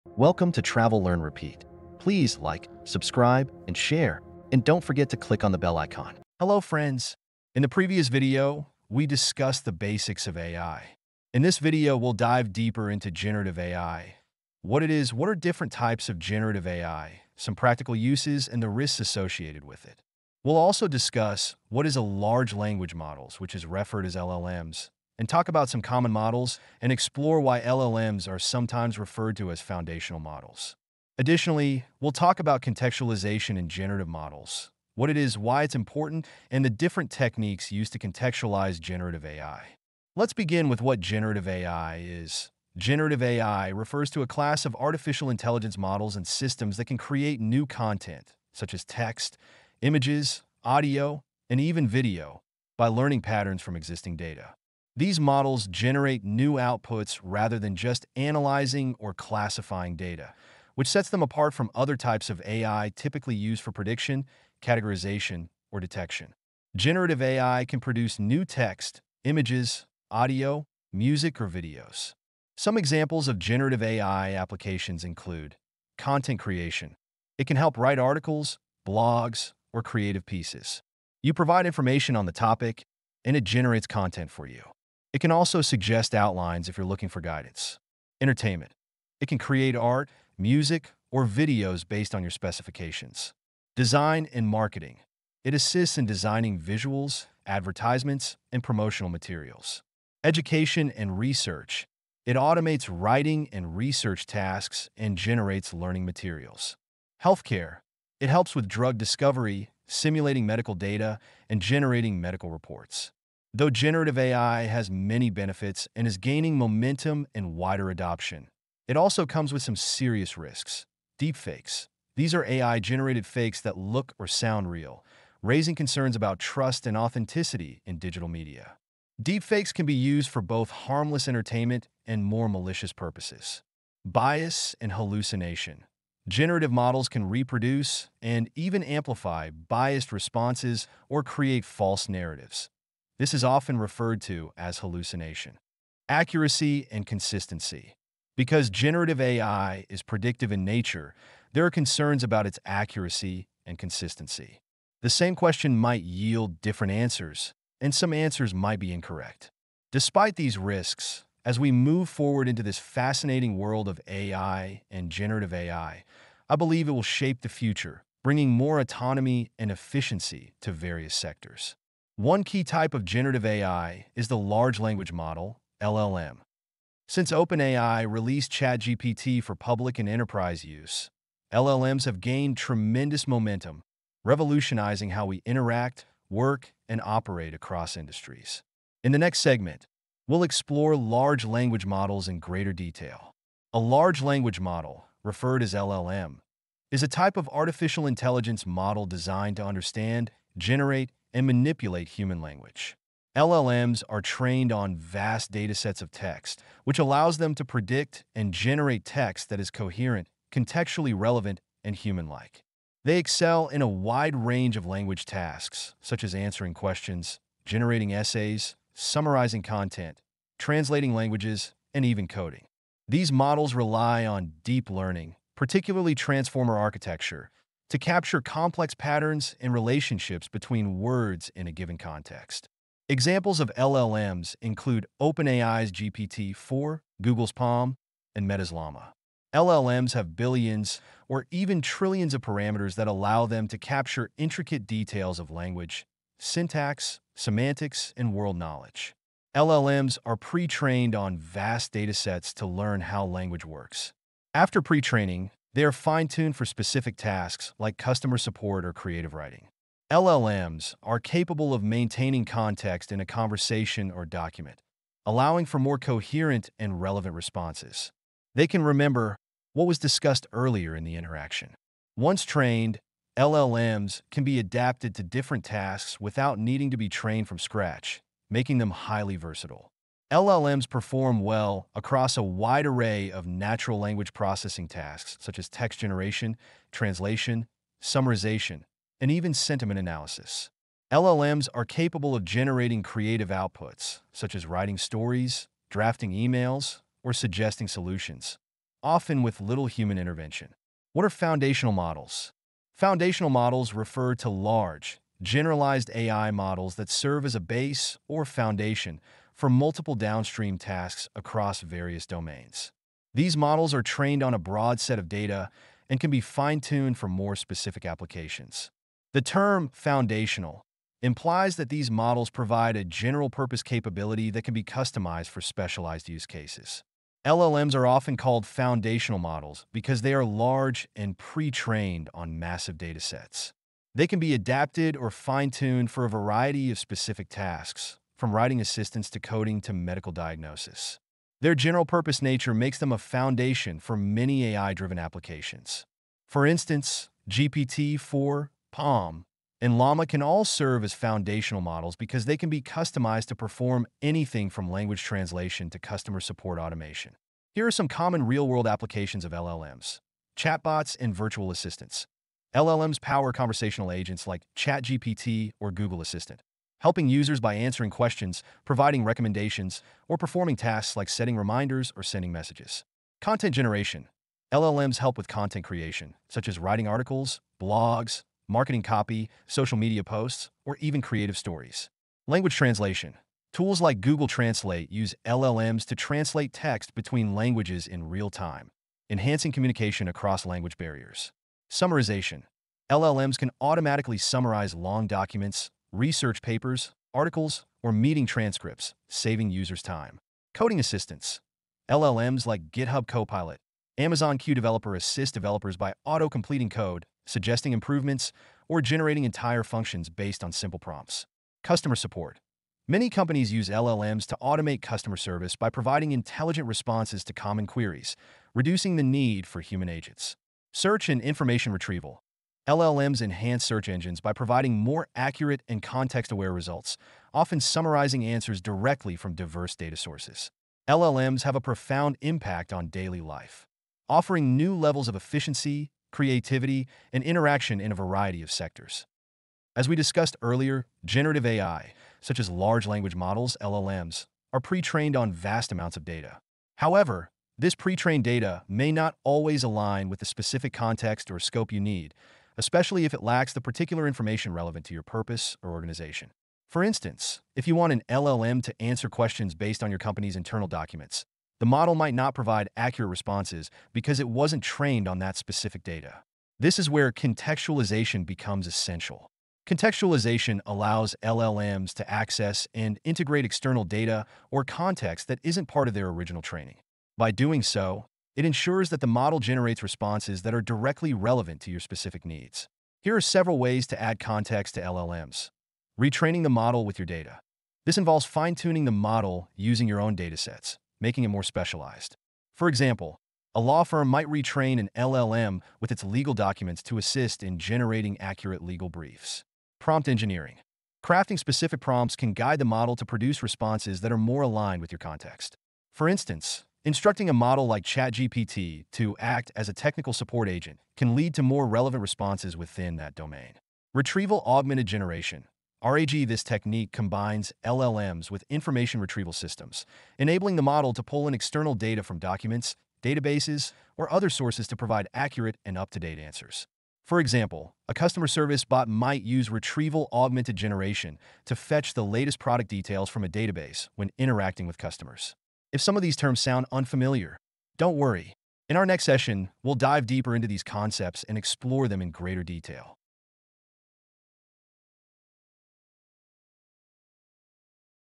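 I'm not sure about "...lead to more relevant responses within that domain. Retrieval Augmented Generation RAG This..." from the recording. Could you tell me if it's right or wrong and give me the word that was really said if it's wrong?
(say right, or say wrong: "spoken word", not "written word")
right.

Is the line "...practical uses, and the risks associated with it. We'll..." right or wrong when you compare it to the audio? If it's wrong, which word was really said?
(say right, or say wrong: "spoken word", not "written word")
right.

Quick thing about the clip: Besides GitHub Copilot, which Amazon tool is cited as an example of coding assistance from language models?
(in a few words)
Amazon Q Developer.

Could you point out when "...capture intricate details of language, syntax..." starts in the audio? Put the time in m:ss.
4:03.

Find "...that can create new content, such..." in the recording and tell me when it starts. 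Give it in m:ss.
0:46.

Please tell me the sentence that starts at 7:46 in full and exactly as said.
This is where contextualization becomes essential.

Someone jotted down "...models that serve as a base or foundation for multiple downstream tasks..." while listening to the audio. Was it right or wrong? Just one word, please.
right.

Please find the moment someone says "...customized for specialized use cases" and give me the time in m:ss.
5:24.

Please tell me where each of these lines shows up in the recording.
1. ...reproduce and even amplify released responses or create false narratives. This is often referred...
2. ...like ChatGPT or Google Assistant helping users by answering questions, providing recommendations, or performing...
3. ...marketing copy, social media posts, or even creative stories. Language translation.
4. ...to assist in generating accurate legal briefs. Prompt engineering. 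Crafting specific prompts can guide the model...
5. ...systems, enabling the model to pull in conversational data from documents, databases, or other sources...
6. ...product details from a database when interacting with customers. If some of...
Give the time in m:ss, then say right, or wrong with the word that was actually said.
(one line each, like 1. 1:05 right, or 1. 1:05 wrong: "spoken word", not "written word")
1. 2:17 wrong: "biased", not "released"
2. 6:04 right
3. 6:18 right
4. 8:17 right
5. 8:39 wrong: "external", not "conversational"
6. 8:52 right.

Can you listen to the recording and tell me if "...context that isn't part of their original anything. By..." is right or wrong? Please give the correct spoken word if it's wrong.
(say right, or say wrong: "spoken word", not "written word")
wrong: "training", not "anything".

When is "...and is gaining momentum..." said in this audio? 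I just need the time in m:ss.
1:55.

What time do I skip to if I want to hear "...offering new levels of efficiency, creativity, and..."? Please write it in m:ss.
7:14.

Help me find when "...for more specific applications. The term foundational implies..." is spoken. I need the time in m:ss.
5:17.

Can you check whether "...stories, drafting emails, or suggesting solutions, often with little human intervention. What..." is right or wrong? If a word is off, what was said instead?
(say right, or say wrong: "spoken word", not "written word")
right.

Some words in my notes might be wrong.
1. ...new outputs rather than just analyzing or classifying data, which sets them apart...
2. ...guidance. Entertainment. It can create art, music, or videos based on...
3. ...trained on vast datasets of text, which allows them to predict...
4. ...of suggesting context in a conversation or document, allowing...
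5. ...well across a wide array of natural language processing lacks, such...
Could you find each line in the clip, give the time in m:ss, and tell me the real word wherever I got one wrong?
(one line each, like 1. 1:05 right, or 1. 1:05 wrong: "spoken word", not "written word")
1. 0:56 right
2. 1:27 right
3. 3:24 right
4. 4:21 wrong: "maintaining", not "suggesting"
5. 4:41 wrong: "tasks", not "lacks".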